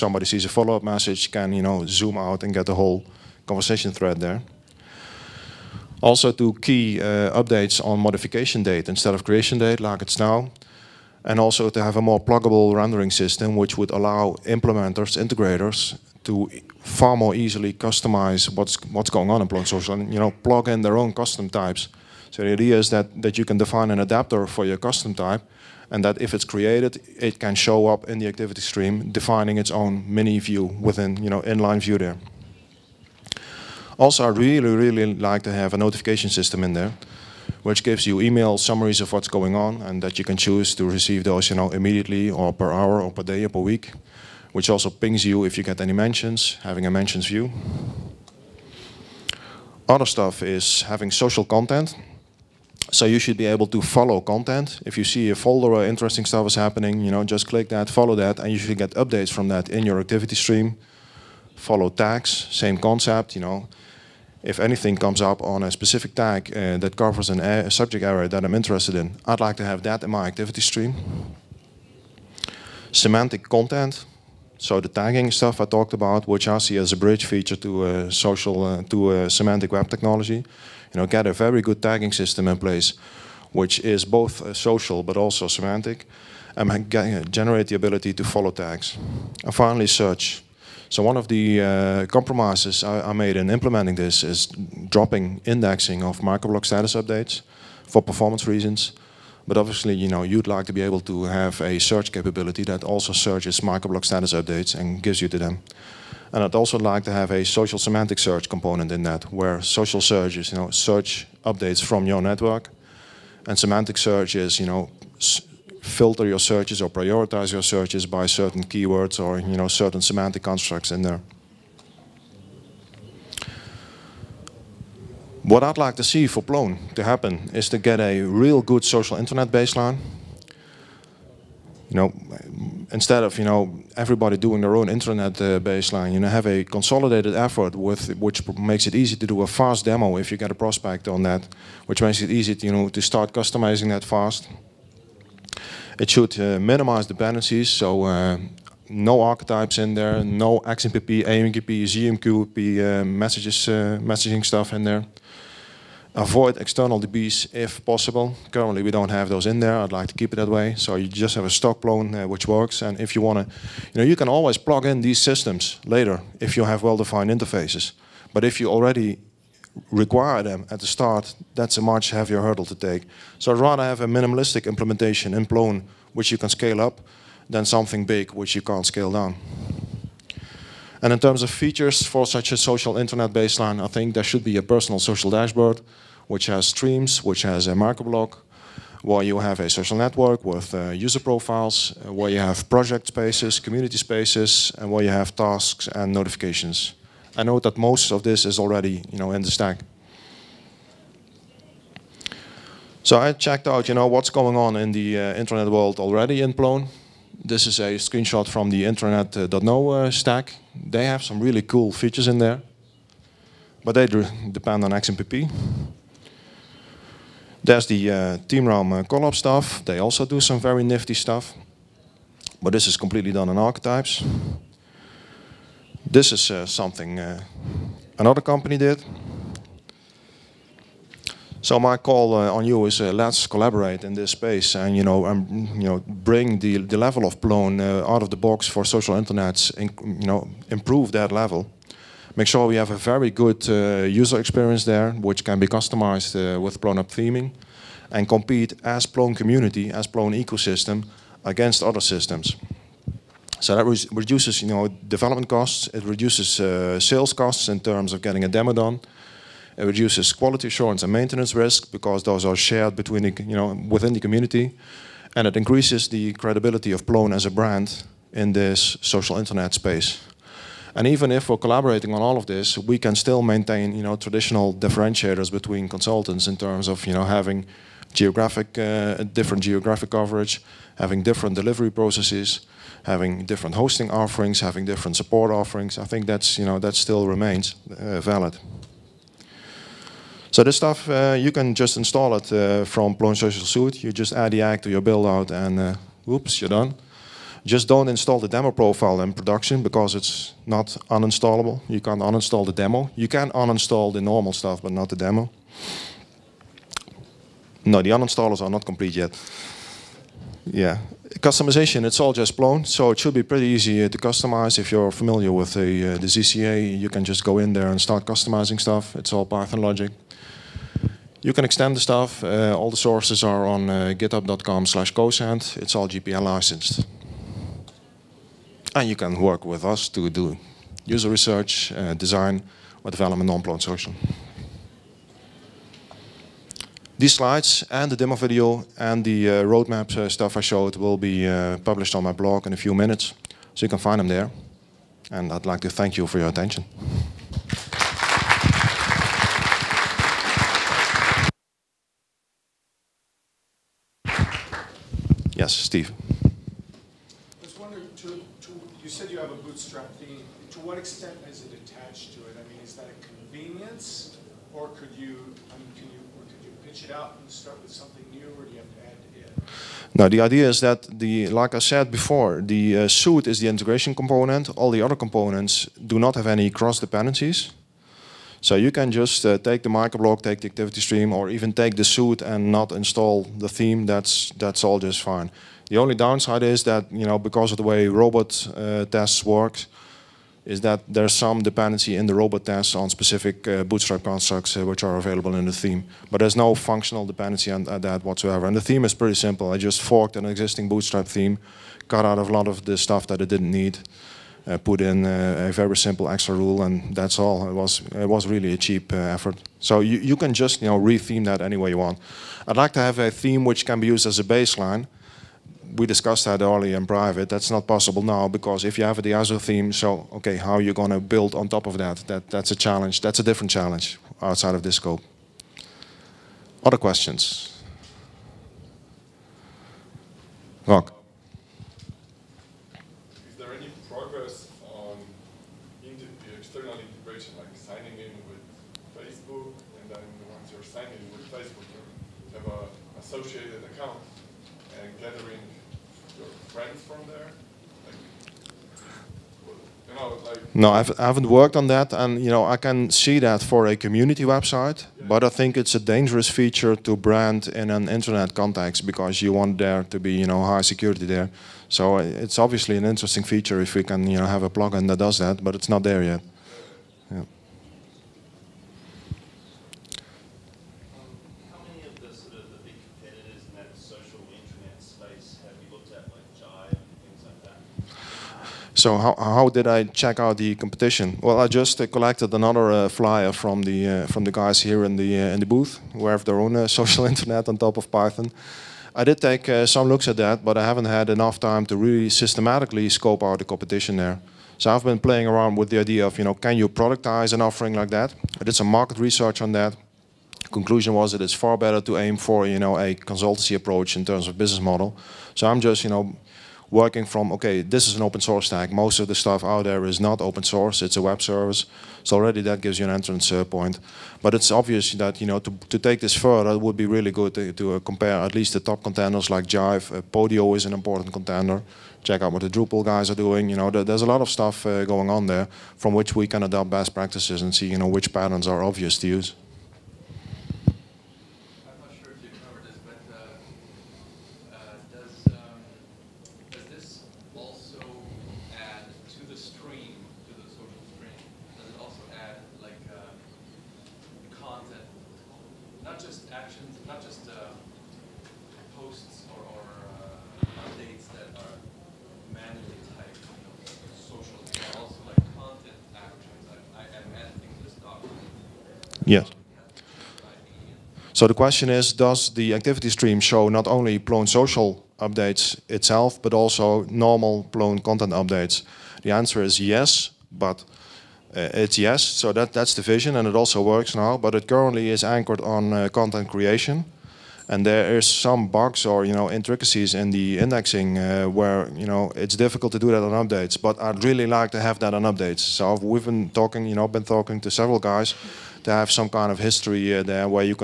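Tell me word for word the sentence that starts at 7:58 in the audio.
So how, how did I check out the competition?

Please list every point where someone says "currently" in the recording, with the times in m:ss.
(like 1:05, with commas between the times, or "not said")
2:38, 9:34.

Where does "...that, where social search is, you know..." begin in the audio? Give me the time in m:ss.
1:49.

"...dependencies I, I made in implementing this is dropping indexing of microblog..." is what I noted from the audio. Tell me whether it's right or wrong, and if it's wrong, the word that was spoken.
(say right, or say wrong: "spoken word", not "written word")
wrong: "compromises", not "dependencies".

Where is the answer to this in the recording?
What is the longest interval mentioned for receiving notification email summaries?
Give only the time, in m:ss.
0:43.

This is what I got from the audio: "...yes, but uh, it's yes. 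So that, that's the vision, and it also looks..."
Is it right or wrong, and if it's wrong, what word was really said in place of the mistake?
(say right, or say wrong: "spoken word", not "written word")
wrong: "works", not "looks".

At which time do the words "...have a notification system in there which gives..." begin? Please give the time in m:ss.
0:35.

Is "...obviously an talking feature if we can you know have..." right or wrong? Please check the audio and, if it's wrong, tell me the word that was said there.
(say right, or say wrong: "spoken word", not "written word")
wrong: "interesting", not "talking".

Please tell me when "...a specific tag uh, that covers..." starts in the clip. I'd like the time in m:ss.
1:05.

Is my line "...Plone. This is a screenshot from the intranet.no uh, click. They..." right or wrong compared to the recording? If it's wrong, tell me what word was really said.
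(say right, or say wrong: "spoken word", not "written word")
wrong: "stack", not "click".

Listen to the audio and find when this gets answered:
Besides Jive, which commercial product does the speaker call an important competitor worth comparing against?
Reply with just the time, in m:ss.
8:40.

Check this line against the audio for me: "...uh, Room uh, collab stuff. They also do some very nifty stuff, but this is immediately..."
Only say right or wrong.
wrong.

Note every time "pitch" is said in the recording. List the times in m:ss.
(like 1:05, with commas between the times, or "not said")
6:06.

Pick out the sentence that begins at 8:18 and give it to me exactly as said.
I did some market research on that.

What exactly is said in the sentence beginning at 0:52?
So you should be able to follow content.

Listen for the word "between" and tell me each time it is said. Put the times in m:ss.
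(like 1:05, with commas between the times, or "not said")
4:22, 4:35.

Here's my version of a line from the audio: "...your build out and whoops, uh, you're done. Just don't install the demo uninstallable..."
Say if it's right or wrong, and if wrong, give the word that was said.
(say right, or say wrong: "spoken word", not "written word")
wrong: "profile", not "uninstallable".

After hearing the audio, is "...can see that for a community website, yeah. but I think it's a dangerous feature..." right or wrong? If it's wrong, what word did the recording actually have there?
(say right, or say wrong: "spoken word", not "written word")
right.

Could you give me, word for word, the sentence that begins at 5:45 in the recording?
And I'd like to thank you for your attention.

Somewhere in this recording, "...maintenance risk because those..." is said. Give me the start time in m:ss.
4:21.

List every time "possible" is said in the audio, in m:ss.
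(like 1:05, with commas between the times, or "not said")
2:37, 6:57.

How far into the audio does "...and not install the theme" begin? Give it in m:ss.
6:22.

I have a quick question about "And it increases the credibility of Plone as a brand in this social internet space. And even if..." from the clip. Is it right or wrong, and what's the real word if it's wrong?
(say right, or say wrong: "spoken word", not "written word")
right.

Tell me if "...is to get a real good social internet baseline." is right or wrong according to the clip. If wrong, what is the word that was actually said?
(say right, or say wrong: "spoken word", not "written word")
right.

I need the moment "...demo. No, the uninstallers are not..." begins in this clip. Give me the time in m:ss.
5:05.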